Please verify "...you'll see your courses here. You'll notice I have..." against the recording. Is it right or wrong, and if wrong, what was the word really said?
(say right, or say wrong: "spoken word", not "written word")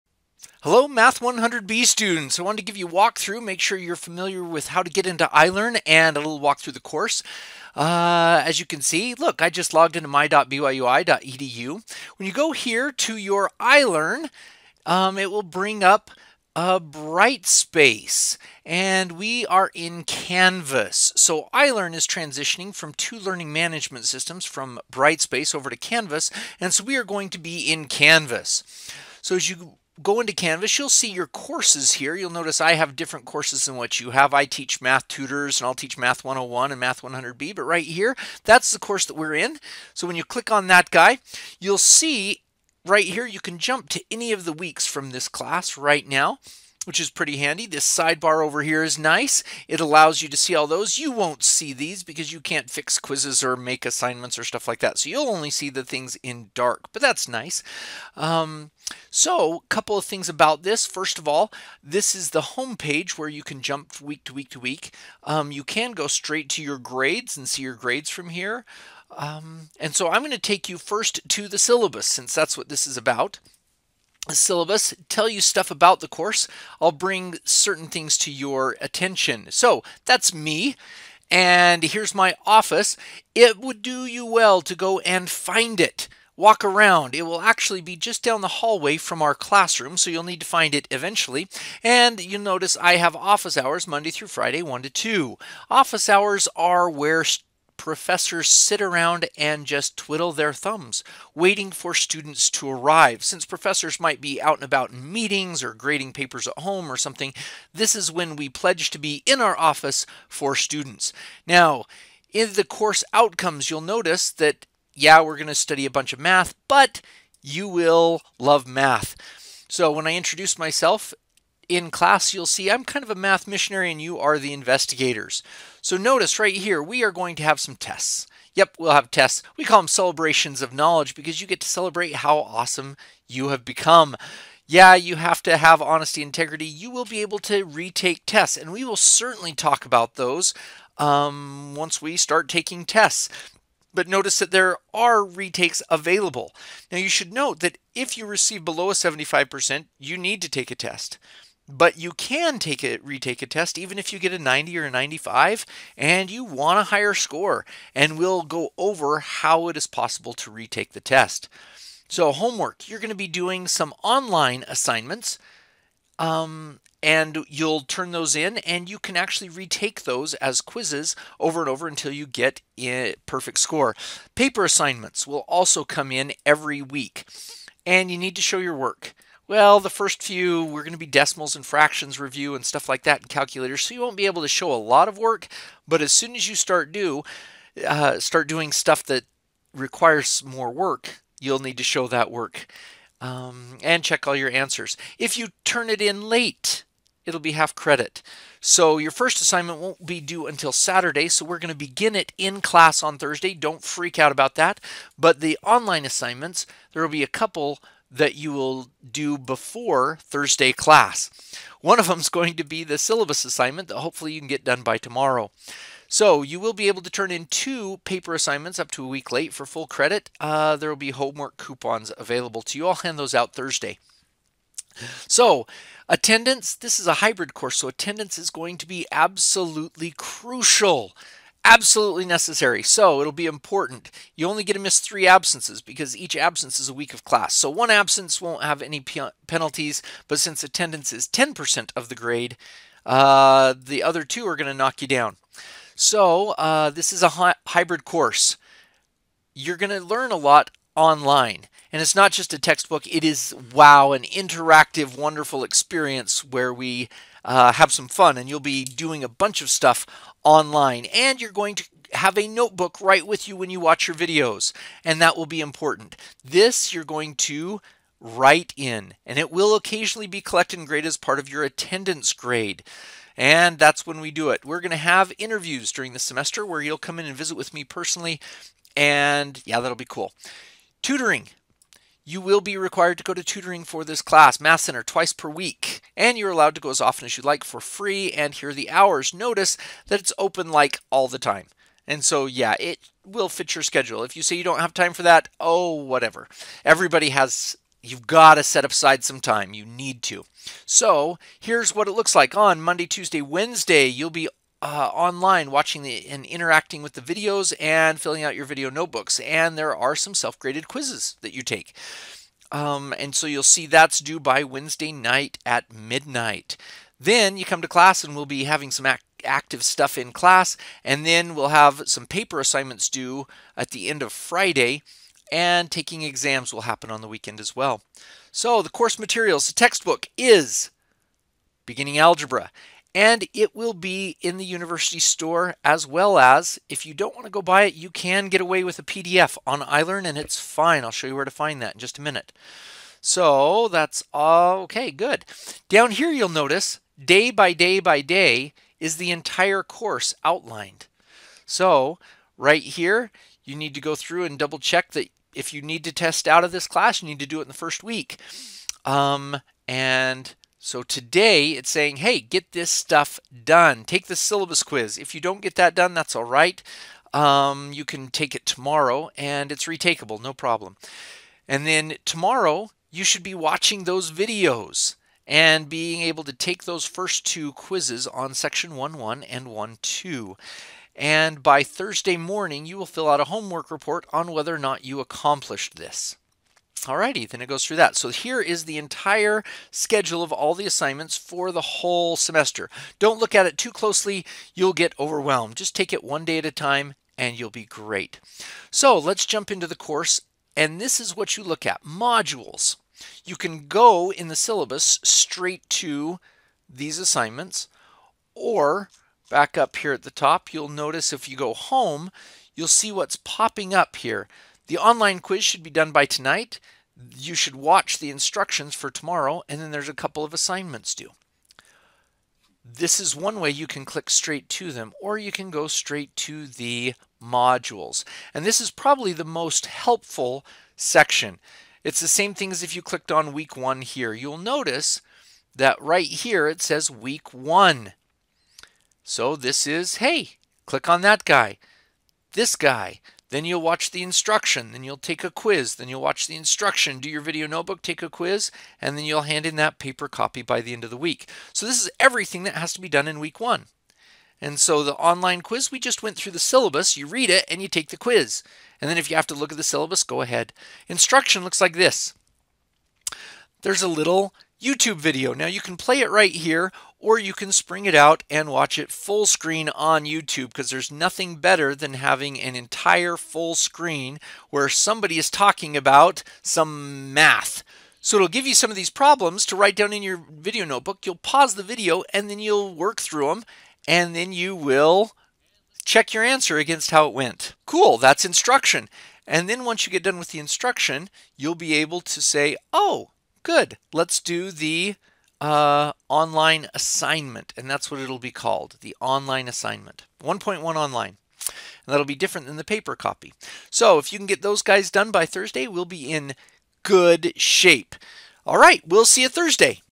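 right.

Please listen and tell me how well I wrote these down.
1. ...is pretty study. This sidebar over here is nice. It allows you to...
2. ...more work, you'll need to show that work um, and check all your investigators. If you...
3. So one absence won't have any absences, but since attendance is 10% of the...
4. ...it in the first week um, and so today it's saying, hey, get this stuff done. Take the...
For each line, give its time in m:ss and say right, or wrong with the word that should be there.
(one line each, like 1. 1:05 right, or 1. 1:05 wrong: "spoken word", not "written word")
1. 0:46 wrong: "handy", not "study"
2. 3:10 wrong: "answers", not "investigators"
3. 3:57 wrong: "penalties", not "absences"
4. 5:57 right.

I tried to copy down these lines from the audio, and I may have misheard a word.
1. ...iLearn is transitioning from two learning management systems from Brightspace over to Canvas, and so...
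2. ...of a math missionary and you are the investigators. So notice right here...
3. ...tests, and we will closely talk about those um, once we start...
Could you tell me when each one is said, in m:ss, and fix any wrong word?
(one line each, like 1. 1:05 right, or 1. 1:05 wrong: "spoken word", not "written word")
1. 0:21 right
2. 2:03 right
3. 2:18 wrong: "certainly", not "closely".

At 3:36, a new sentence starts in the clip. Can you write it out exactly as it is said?
So you will be able to turn in two paper assignments up to a week late for full credit.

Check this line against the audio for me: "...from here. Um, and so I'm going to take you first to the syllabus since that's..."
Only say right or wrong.
right.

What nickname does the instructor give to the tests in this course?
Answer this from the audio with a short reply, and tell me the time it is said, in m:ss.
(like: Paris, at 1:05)
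celebrations of knowledge, at 2:09.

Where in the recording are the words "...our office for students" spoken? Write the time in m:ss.
1:49.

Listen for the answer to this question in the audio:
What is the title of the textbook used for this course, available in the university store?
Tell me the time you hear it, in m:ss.
5:31.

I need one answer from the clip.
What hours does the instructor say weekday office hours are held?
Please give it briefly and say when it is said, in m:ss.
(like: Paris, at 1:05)
1 to 2, at 1:34.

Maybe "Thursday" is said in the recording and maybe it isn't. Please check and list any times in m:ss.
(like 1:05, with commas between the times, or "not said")
3:23, 3:30, 3:43, 6:21, 8:25, 8:29.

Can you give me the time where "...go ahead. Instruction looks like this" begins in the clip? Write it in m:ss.
7:40.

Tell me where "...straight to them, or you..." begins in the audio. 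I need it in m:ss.
7:04.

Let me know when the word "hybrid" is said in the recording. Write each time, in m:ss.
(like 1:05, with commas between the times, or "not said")
3:47, 4:07.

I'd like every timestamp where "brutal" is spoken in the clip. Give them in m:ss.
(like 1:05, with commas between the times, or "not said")
not said.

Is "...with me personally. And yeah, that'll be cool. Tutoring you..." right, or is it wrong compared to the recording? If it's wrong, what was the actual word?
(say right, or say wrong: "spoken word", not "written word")
right.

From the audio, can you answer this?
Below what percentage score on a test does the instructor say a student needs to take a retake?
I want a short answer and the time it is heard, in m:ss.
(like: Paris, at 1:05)
75%, at 2:28.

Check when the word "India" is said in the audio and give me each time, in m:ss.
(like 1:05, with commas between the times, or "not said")
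not said.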